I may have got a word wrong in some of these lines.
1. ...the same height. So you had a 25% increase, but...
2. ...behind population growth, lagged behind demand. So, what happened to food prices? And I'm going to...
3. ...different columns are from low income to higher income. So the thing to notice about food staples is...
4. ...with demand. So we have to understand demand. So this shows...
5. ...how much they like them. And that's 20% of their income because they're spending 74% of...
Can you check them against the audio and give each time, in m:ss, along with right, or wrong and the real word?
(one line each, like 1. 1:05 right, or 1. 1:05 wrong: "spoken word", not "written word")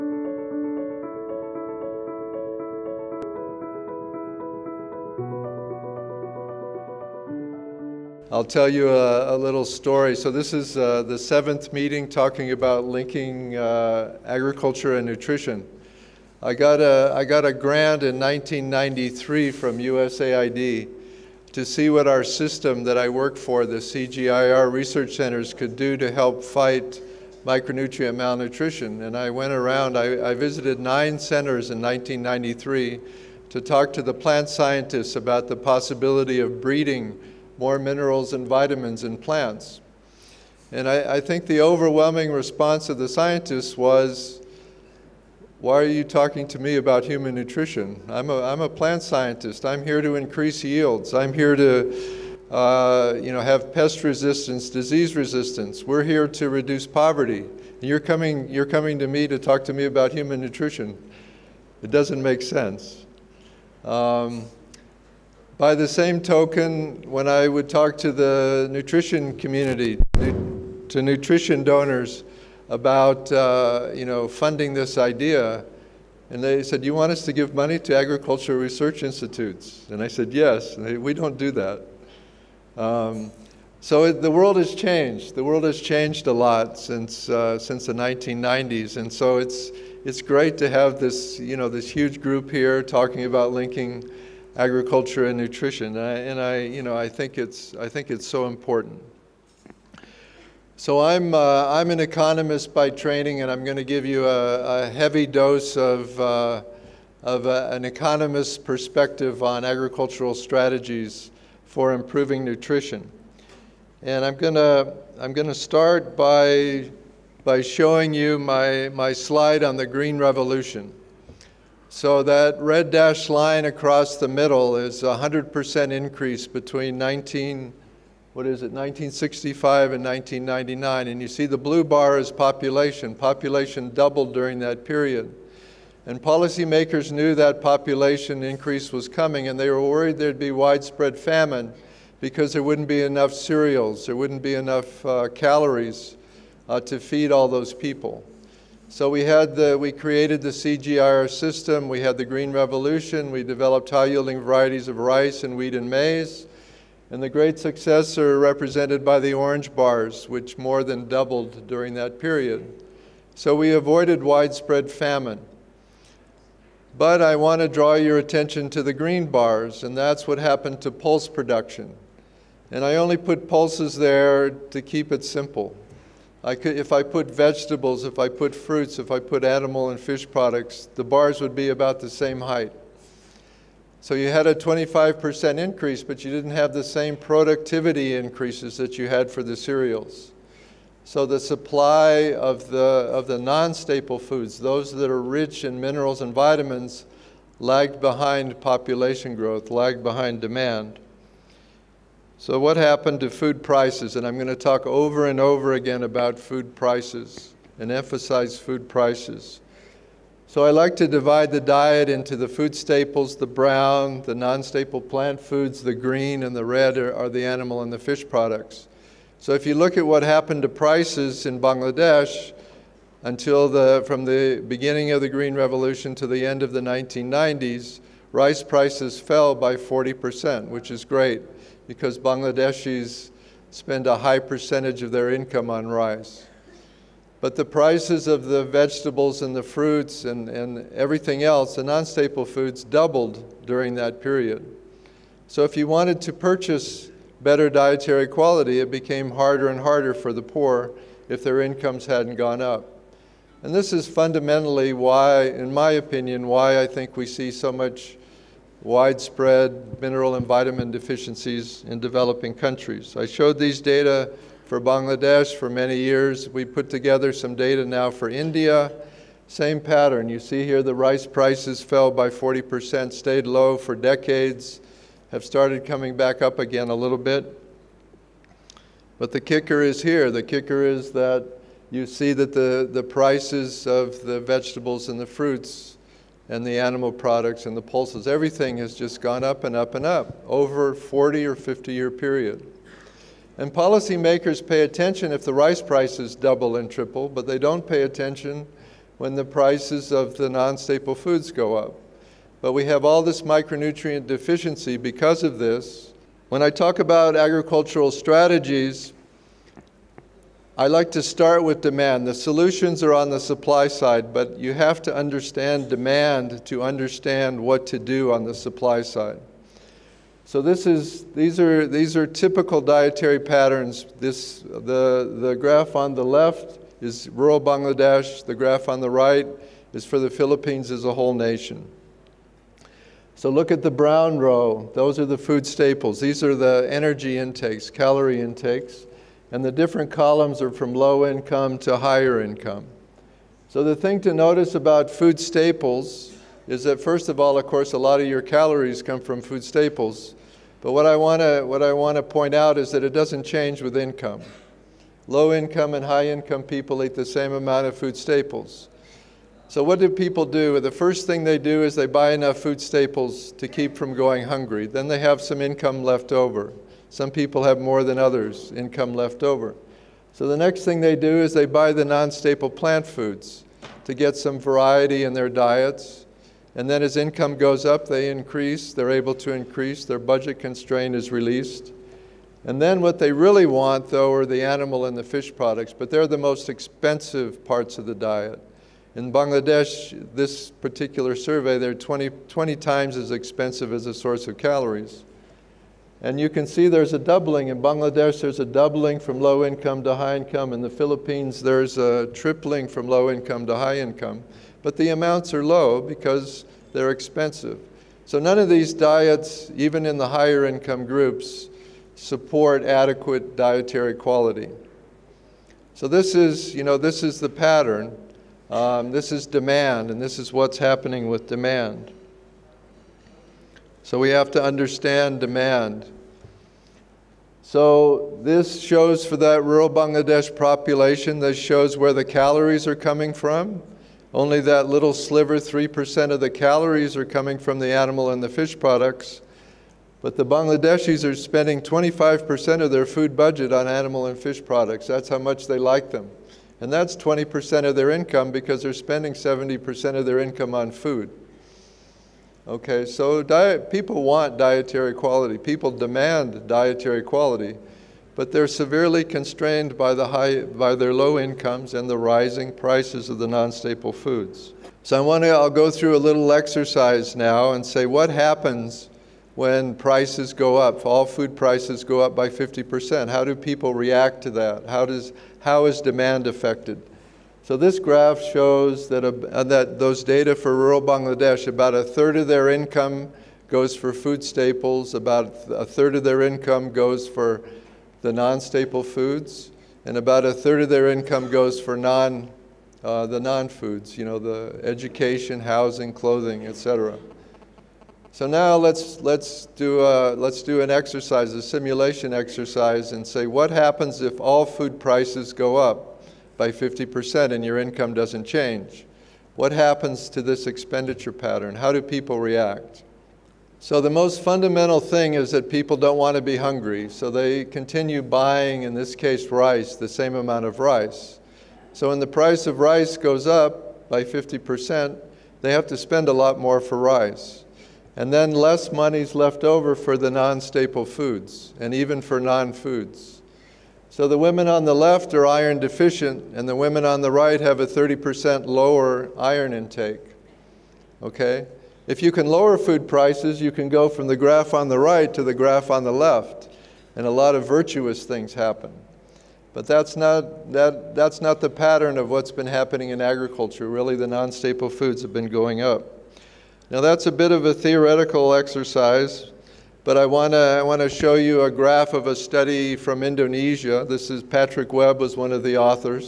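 1. 3:02 right
2. 3:18 right
3. 5:39 right
4. 7:01 right
5. 7:25 wrong: "70", not "74".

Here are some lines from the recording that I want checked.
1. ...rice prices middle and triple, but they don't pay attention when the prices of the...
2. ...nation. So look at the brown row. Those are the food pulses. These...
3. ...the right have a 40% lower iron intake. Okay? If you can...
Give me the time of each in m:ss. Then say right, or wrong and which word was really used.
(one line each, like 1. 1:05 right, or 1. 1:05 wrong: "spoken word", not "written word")
1. 4:55 wrong: "double", not "middle"
2. 5:31 wrong: "staples", not "pulses"
3. 8:57 wrong: "30", not "40".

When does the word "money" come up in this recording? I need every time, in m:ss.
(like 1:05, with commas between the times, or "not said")
1:17, 8:48.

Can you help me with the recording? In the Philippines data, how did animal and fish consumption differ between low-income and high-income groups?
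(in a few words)
Tripling.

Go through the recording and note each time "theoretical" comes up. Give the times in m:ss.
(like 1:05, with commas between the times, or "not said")
9:17.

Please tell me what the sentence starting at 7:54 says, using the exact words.
How, does, how is demand affected?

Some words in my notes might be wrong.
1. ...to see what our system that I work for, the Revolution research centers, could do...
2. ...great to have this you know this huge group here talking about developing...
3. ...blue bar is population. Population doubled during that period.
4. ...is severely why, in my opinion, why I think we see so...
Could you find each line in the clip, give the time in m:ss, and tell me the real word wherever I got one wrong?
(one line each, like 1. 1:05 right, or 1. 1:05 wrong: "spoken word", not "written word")
1. 0:21 wrong: "CGIAR", not "Revolution"
2. 1:30 wrong: "linking", not "developing"
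3. 2:11 right
4. 4:13 wrong: "fundamentally", not "severely".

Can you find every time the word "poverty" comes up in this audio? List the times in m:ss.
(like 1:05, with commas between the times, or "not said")
0:56.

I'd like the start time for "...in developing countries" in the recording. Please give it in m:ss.
4:21.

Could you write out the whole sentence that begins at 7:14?
Only that little sliver, 3% of the calories are coming from the animal and the fish products.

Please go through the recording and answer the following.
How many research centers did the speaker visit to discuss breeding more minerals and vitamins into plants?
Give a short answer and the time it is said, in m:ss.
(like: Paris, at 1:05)
9, at 0:30.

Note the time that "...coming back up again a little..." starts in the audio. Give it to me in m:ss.
4:35.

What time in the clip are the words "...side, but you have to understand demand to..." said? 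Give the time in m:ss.
5:13.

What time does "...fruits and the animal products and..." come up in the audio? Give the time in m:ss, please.
4:45.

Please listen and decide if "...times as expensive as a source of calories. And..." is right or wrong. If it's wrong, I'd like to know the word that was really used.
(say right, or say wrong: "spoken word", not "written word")
right.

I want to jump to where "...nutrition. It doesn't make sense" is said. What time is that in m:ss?
1:00.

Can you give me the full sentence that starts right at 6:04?
Then they have some income left over.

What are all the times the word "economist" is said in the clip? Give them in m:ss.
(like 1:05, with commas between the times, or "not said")
1:42, 1:47.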